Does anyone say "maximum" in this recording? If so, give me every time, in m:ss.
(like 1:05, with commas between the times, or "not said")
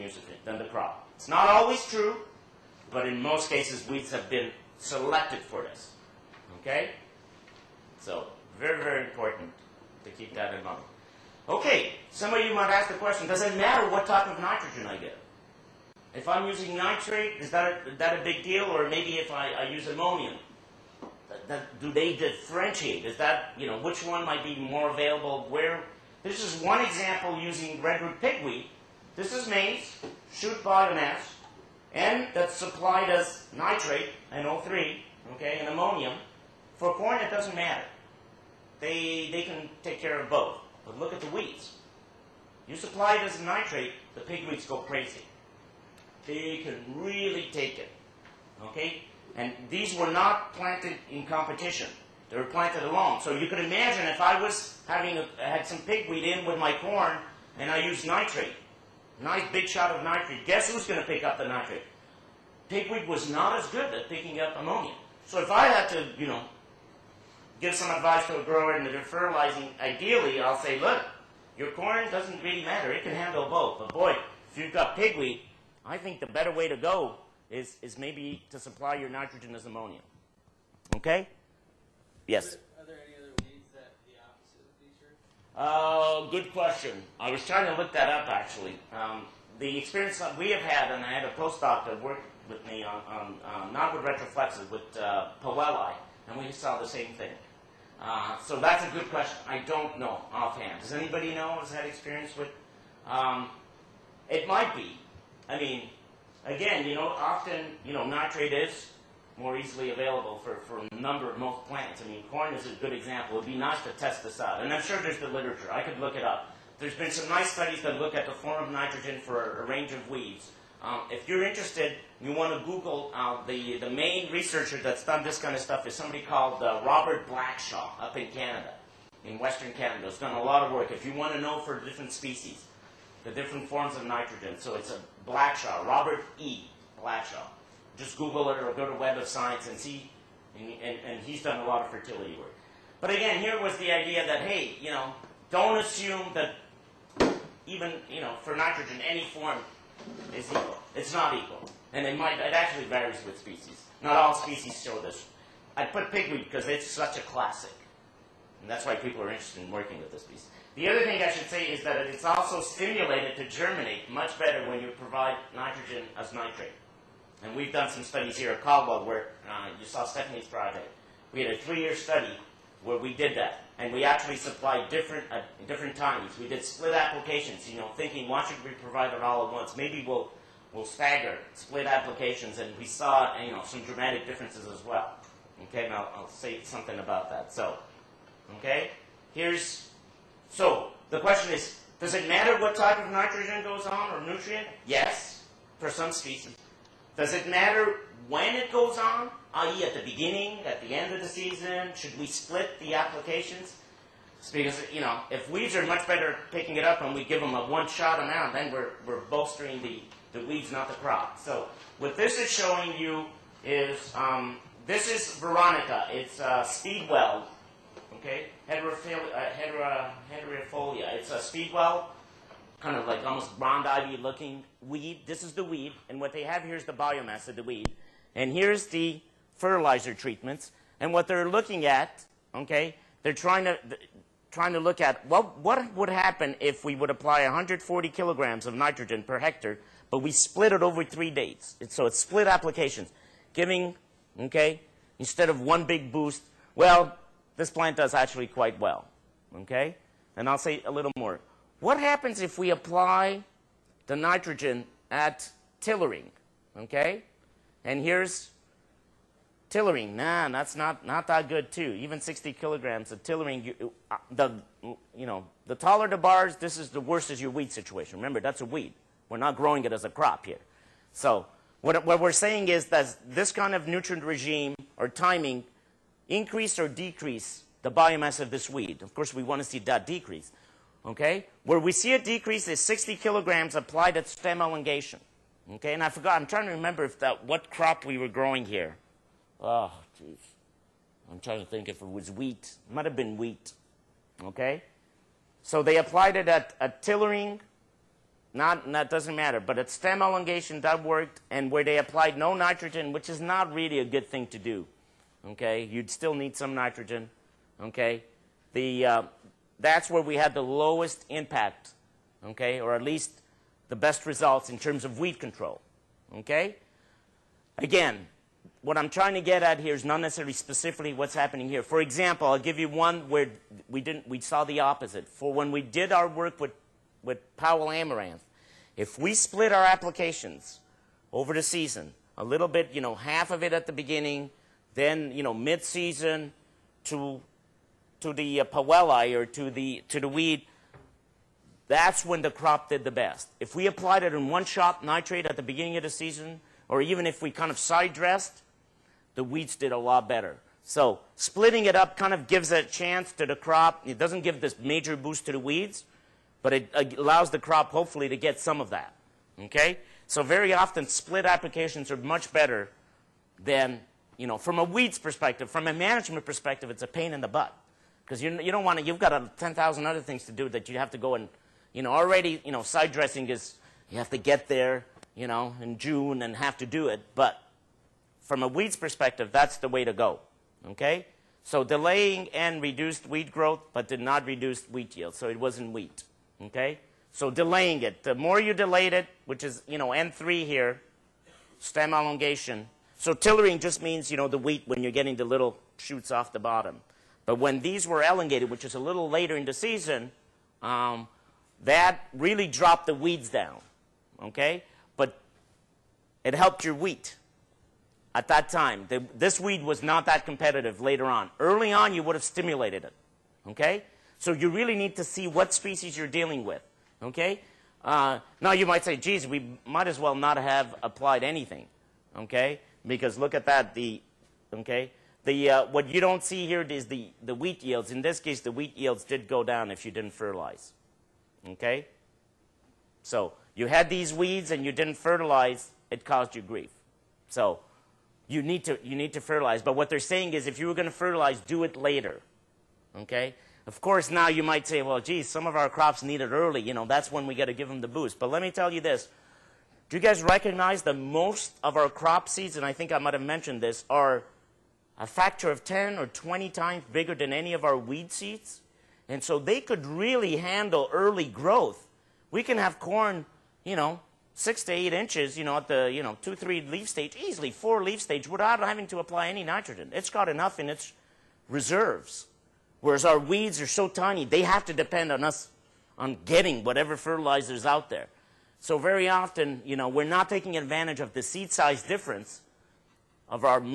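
not said.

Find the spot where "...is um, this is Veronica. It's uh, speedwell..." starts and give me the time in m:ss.
3:33.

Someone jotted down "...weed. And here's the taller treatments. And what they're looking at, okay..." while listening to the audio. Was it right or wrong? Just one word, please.
wrong.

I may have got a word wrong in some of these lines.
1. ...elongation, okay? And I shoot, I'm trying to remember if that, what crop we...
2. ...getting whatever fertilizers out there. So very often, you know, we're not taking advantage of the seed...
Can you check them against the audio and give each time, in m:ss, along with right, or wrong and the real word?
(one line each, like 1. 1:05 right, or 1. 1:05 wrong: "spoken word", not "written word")
1. 4:44 wrong: "forgot", not "shoot"
2. 7:56 right.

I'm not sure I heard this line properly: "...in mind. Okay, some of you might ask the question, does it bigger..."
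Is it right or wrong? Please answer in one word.
wrong.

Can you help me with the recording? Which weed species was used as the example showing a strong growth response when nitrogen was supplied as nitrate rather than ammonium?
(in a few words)
Redroot pigweed.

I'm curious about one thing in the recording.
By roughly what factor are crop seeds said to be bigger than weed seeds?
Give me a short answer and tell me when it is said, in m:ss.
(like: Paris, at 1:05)
10 or 20 times, at 7:35.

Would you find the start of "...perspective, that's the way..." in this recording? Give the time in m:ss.
6:18.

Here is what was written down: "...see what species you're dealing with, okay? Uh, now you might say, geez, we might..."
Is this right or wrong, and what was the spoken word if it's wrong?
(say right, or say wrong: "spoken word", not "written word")
right.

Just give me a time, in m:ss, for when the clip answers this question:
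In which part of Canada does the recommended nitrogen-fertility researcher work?
2:09.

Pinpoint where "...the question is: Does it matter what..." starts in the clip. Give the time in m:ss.
3:11.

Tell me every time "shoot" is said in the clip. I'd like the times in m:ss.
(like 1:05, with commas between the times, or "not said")
0:30, 6:35.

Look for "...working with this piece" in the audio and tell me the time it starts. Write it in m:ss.
2:39.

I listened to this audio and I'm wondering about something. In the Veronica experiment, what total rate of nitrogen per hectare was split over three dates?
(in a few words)
140 kg.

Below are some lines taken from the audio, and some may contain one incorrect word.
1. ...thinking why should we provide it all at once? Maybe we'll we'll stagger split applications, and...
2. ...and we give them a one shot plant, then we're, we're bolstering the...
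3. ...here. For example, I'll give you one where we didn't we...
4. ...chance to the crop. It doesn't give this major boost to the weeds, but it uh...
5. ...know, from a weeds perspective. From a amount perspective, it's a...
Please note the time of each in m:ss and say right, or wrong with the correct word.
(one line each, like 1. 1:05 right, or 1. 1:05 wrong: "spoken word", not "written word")
1. 2:57 right
2. 3:27 wrong: "amount", not "plant"
3. 5:21 right
4. 5:52 right
5. 6:04 wrong: "management", not "amount".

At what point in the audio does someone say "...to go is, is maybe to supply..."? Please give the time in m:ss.
1:16.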